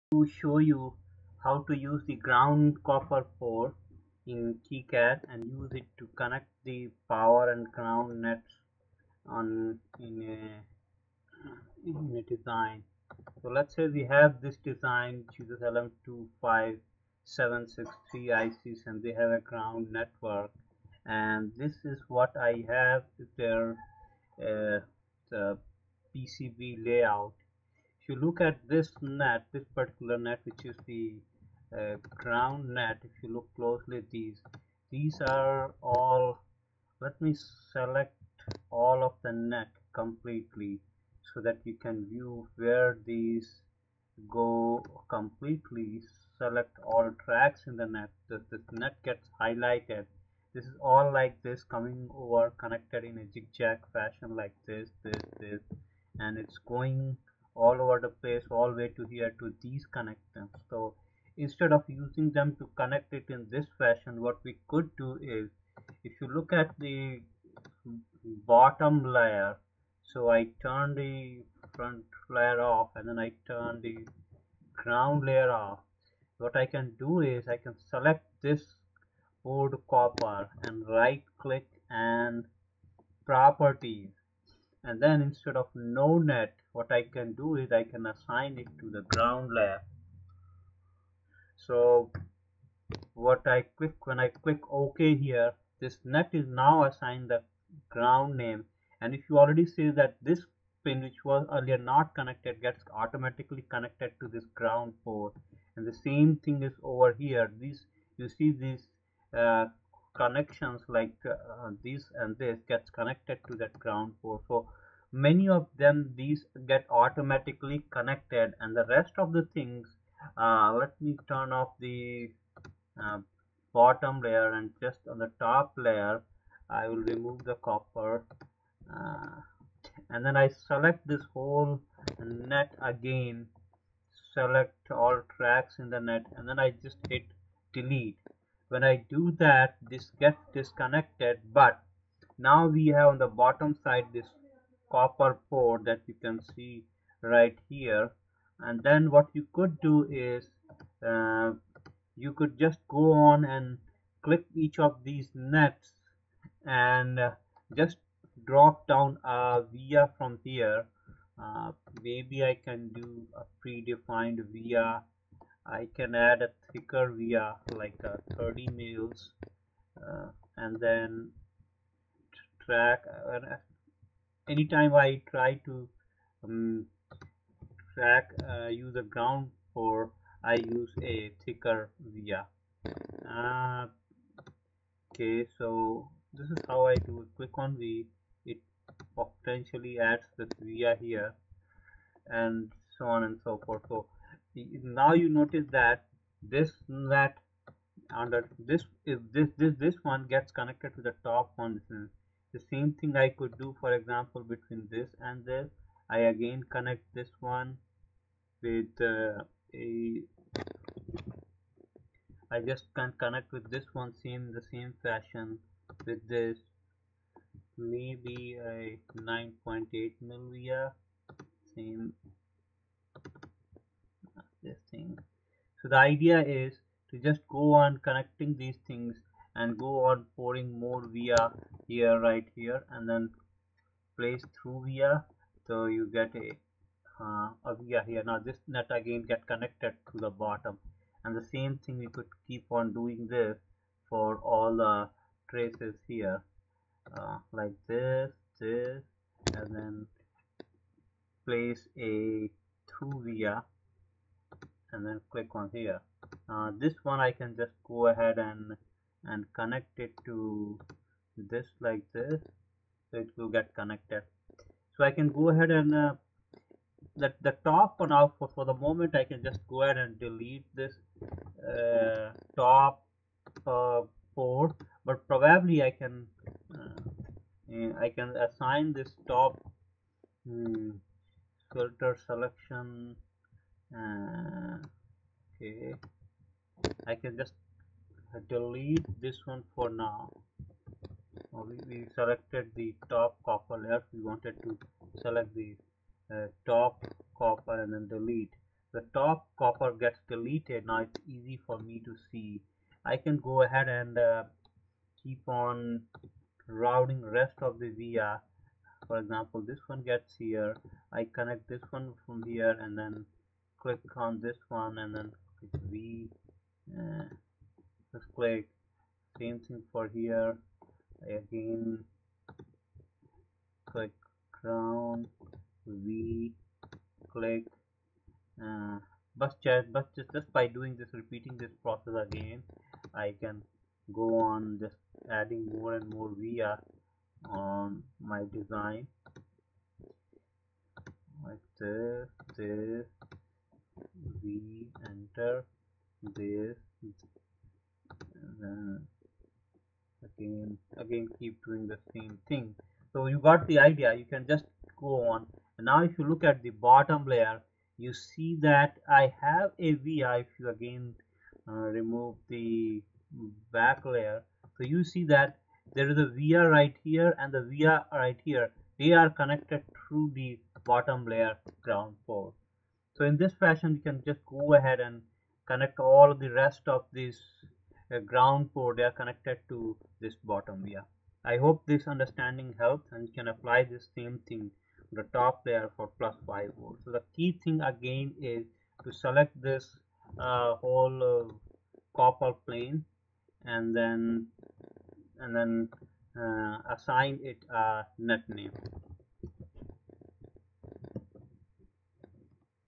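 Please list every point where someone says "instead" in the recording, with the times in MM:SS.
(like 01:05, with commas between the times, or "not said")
01:01, 01:25.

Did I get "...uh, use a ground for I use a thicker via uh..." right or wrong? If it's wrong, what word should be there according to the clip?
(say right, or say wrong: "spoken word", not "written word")
right.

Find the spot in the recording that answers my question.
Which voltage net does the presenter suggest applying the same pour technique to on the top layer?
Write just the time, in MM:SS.
06:26.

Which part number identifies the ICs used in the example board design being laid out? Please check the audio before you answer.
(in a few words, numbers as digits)
LM25763.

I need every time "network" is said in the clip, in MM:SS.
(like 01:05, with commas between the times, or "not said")
00:19.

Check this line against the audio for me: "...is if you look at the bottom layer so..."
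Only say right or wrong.
right.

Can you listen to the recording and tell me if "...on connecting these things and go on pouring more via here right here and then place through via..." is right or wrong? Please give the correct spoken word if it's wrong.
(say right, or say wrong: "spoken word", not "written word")
right.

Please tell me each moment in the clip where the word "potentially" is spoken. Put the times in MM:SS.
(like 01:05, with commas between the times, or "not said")
03:09.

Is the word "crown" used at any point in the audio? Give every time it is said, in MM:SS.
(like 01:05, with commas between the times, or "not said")
05:24.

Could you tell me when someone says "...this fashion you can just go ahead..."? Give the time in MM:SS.
06:13.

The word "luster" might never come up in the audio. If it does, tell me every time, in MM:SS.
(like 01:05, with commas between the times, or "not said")
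not said.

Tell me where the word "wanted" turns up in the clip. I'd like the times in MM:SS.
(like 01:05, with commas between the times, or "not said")
04:54.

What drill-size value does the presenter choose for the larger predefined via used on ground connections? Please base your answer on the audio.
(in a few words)
30 mils.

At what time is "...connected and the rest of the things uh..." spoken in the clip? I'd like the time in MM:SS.
01:57.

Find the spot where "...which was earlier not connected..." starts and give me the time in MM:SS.
01:41.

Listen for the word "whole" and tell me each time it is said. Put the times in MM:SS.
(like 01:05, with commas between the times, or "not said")
02:11, 06:30.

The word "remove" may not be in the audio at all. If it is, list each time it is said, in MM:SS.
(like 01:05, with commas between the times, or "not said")
02:07, 06:01.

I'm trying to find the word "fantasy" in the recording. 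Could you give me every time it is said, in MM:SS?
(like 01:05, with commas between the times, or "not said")
not said.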